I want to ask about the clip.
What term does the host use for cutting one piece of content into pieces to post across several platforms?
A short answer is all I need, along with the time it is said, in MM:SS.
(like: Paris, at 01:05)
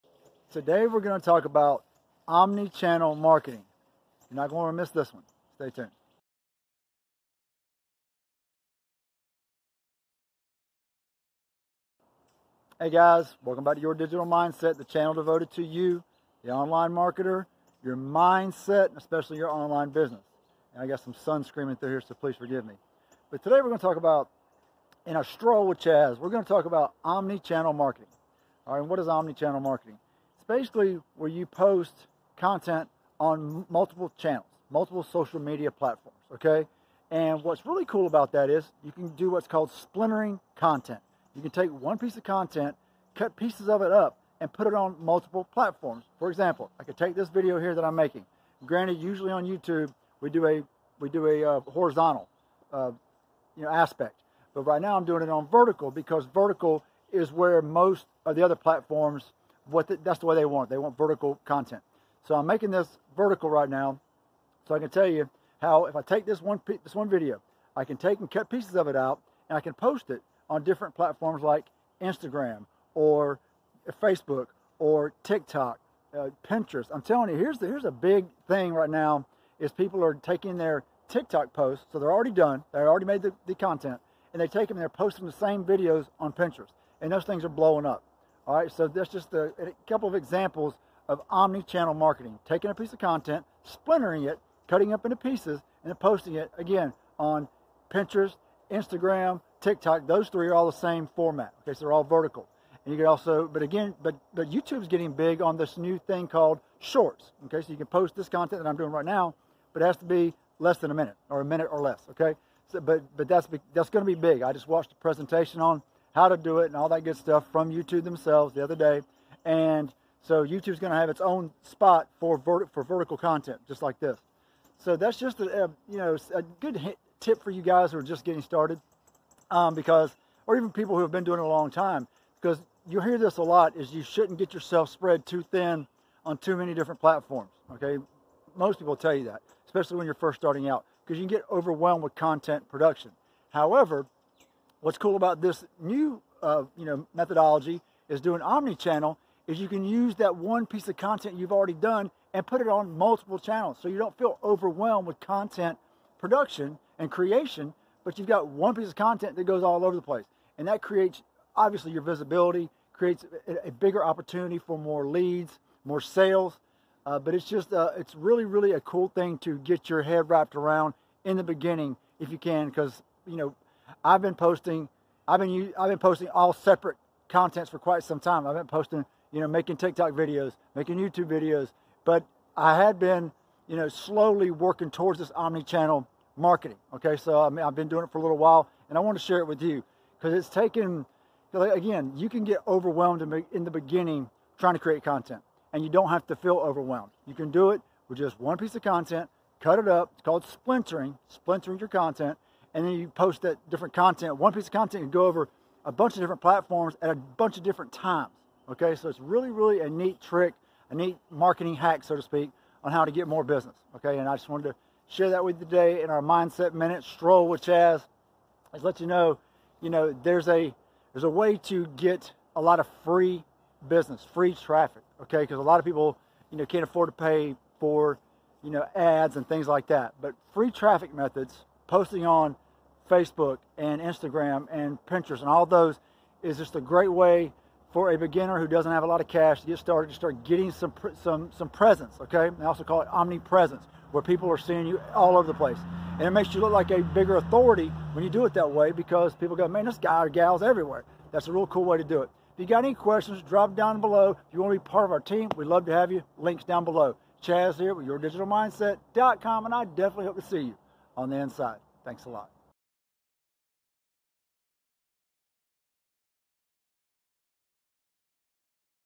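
Splintering content, at 00:39.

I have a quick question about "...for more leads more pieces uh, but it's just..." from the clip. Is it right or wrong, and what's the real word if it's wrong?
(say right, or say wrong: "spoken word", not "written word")
wrong: "sales", not "pieces".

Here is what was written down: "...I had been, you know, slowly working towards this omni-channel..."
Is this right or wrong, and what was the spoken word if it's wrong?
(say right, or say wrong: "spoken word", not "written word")
right.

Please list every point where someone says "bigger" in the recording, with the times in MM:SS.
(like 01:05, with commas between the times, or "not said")
02:43, 04:06.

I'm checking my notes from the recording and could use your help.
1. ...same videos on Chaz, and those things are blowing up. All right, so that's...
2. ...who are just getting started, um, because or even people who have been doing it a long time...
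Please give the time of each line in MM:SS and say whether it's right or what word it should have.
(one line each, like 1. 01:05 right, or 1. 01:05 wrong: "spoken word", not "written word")
1. 01:25 wrong: "Pinterest", not "Chaz"
2. 02:07 right.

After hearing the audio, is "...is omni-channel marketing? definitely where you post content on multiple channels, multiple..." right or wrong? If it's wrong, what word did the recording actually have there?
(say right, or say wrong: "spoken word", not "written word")
wrong: "basically", not "definitely".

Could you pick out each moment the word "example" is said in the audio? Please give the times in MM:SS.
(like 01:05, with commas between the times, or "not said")
00:46, 01:30.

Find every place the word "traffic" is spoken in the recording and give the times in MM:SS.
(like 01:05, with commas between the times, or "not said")
03:44, 03:50.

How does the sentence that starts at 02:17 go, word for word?
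Okay, most people tell you that, especially when you're first starting out, because you can get overwhelmed with content production.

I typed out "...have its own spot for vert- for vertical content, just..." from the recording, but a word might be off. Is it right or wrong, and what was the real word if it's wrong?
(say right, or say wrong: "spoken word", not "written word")
right.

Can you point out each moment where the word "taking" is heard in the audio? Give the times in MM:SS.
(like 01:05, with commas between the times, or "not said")
01:20, 01:32.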